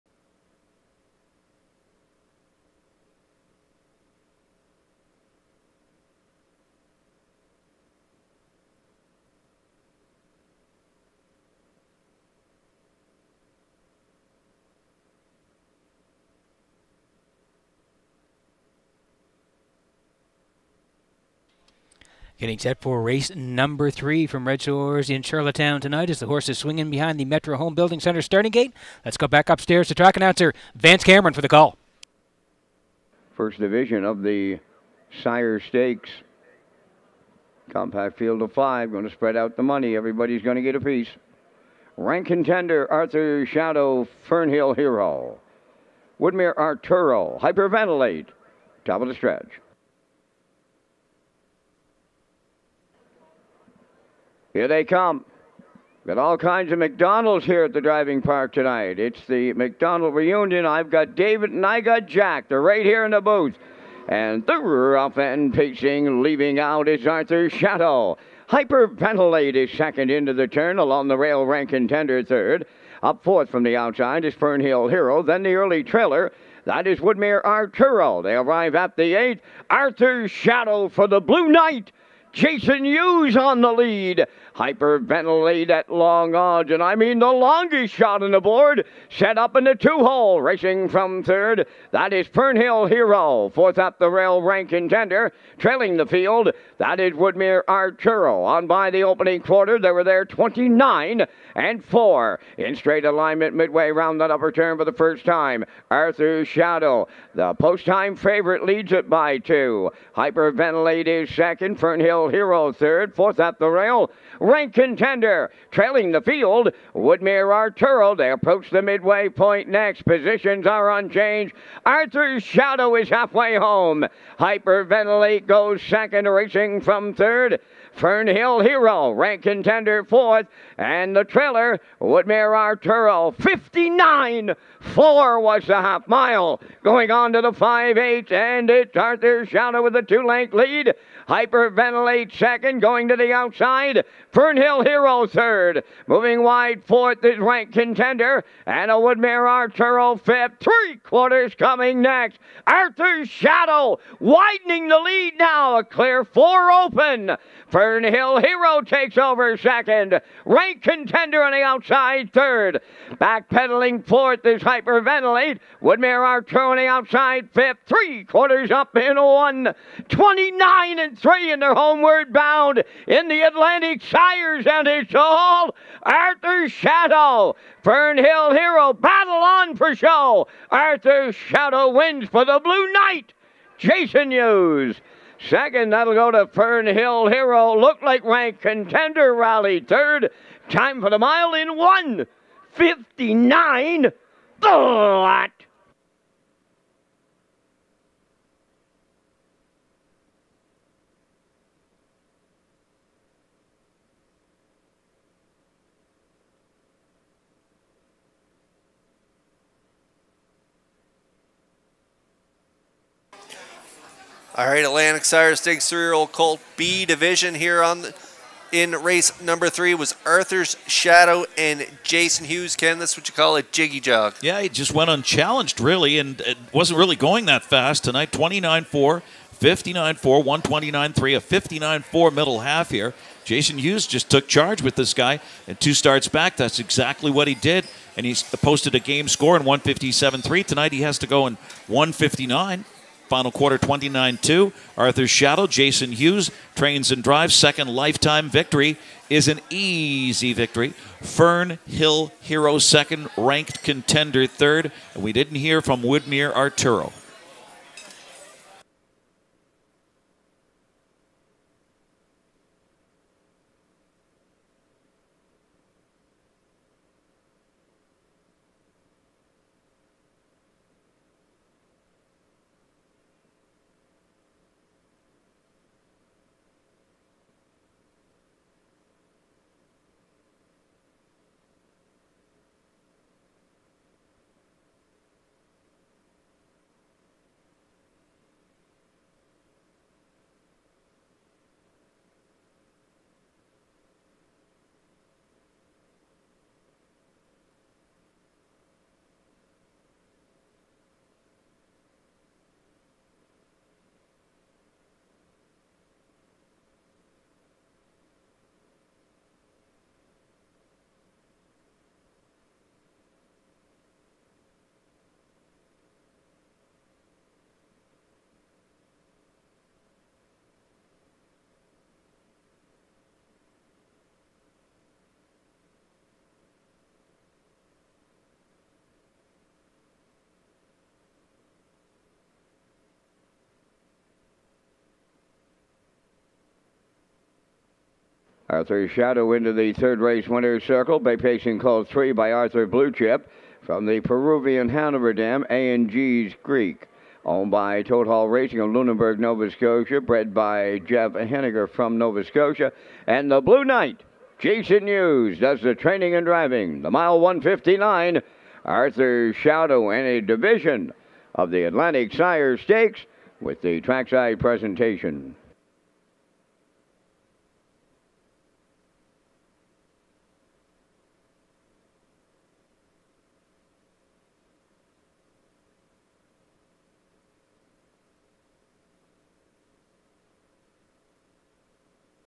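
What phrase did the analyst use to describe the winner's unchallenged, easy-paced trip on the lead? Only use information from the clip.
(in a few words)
jiggy jog.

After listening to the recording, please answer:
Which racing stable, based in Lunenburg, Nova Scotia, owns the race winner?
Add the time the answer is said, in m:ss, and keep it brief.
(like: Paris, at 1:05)
Total Racing, at 5:48.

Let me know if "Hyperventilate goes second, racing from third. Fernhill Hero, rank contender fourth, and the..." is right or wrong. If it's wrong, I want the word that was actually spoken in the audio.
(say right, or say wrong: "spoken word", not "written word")
right.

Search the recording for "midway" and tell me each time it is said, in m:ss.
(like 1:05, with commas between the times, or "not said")
1:43, 1:58.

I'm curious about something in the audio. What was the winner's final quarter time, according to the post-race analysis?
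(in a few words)
29.2.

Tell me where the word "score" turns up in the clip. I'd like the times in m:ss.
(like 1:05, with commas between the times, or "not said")
3:59.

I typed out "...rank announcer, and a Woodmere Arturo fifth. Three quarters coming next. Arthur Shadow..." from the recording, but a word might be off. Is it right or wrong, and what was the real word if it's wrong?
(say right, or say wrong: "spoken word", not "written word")
wrong: "contender", not "announcer".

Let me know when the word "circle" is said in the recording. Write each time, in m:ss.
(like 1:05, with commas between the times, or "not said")
5:40.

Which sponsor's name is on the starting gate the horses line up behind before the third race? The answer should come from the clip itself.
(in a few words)
Metro Home Building Center.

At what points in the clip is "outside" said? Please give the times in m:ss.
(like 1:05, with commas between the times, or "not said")
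1:13, 2:23, 2:41, 2:46.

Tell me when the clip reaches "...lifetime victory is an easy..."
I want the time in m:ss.
4:07.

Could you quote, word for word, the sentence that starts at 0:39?
Everybody's going to get a piece.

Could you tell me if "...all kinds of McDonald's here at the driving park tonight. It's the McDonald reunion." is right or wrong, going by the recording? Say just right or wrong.
right.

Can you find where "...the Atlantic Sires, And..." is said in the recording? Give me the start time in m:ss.
2:53.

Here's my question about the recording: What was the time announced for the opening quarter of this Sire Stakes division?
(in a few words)
29.4.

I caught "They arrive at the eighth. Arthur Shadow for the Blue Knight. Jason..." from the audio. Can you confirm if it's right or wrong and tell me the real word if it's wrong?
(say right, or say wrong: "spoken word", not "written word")
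right.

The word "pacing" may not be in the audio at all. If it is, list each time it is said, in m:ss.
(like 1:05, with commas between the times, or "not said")
1:05, 5:41.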